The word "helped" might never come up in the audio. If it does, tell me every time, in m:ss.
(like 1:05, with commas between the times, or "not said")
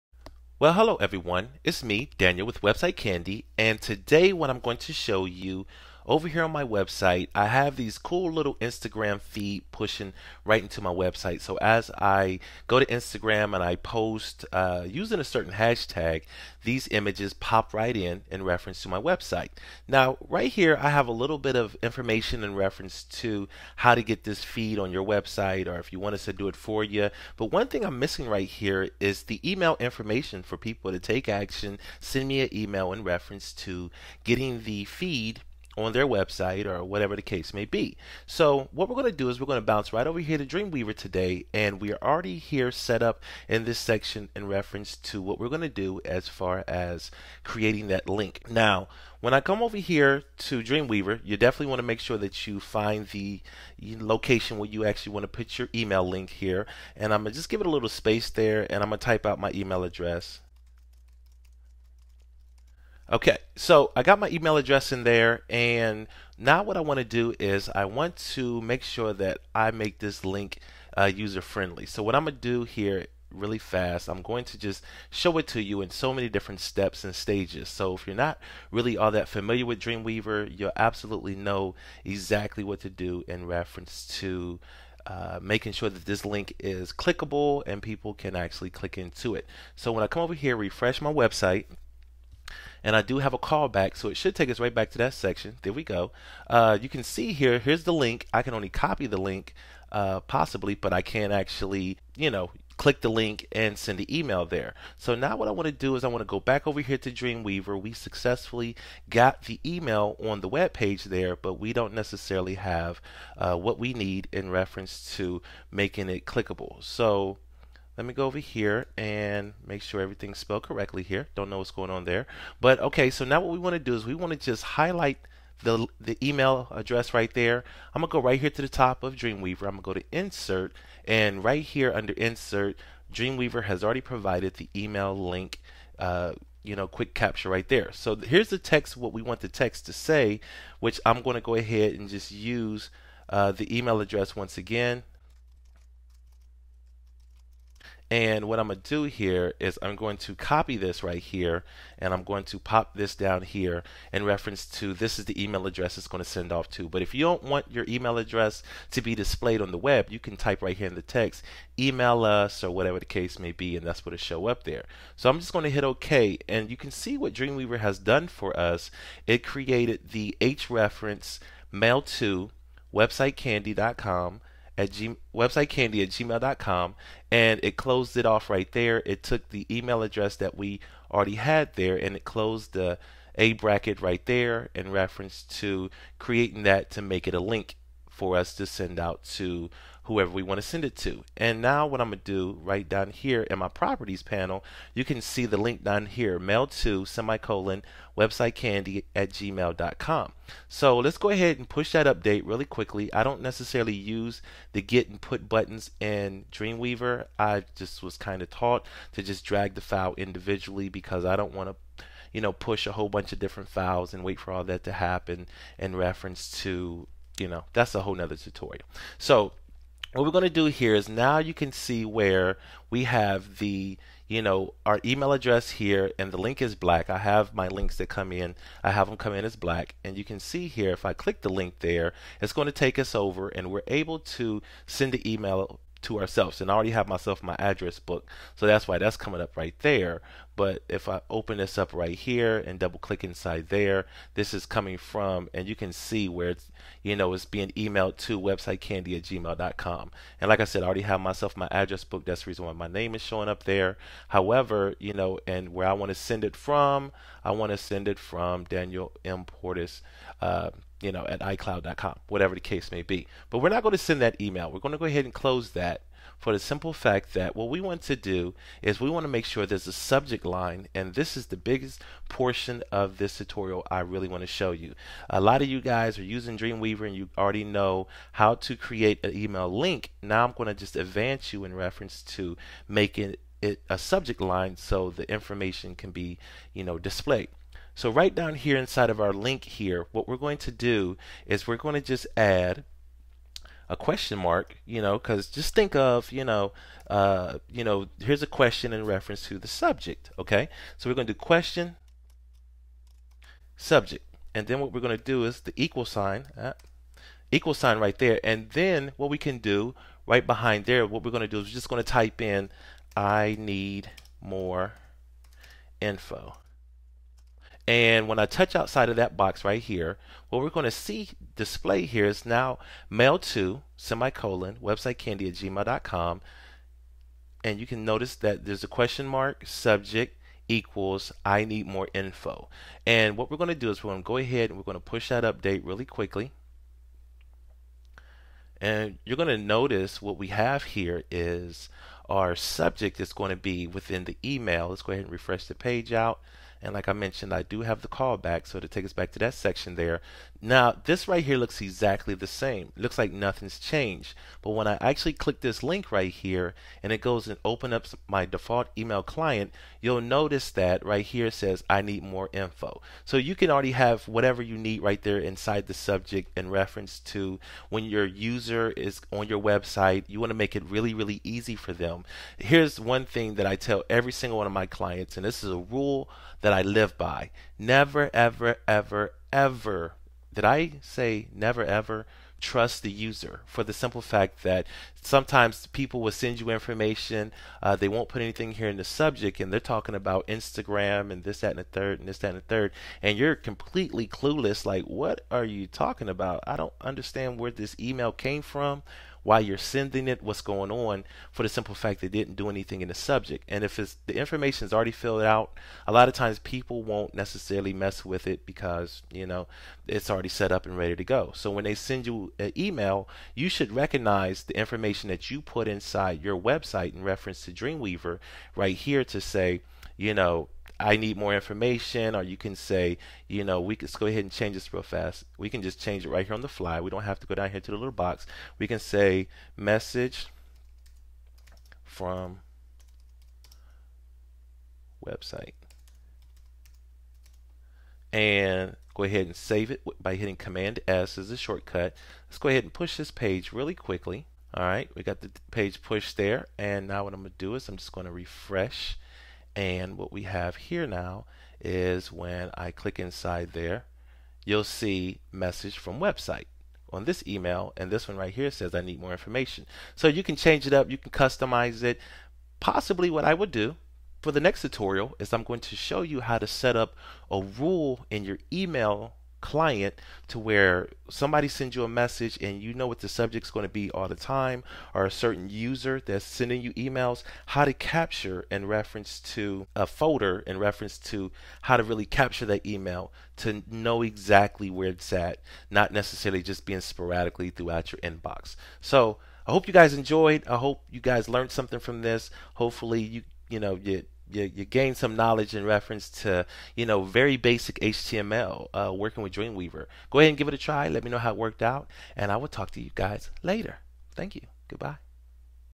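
not said.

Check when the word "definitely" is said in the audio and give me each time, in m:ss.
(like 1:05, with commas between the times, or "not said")
0:51.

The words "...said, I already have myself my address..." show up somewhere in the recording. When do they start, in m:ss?
4:10.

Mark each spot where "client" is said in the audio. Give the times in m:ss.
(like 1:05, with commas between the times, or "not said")
5:59, 6:14, 7:49.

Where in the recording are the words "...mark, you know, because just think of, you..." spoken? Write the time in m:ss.
4:54.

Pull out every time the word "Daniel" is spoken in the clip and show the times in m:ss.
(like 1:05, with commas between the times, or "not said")
0:02, 4:18.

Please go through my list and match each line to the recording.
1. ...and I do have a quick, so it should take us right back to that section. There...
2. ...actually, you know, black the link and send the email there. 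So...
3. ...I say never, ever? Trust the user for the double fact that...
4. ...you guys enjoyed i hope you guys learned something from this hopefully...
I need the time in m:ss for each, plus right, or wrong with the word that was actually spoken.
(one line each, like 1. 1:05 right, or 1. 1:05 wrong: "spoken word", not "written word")
1. 1:32 wrong: "callback", not "quick"
2. 1:41 wrong: "click", not "black"
3. 6:20 wrong: "simple", not "double"
4. 8:09 right.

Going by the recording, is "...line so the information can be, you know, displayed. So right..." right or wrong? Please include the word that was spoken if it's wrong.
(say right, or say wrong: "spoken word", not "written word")
right.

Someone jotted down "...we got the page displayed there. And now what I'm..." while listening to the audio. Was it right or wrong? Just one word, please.
wrong.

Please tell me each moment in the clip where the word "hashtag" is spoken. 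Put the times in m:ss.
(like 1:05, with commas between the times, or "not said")
0:15.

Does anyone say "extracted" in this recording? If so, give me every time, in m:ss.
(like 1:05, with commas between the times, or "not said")
not said.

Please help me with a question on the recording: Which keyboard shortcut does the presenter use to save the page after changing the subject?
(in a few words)
Command S.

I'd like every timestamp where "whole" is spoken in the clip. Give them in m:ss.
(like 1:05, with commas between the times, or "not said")
3:32, 3:38.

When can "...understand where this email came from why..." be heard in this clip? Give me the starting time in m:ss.
6:37.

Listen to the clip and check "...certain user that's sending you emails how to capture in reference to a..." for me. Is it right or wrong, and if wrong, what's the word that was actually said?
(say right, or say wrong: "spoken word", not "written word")
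right.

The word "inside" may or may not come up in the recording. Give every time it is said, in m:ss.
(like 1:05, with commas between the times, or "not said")
4:03, 4:48, 6:05, 6:55, 7:33.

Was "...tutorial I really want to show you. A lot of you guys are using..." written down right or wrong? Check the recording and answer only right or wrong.
right.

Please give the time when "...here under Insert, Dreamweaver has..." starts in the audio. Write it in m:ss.
2:11.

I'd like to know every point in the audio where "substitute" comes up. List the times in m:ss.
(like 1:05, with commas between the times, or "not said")
not said.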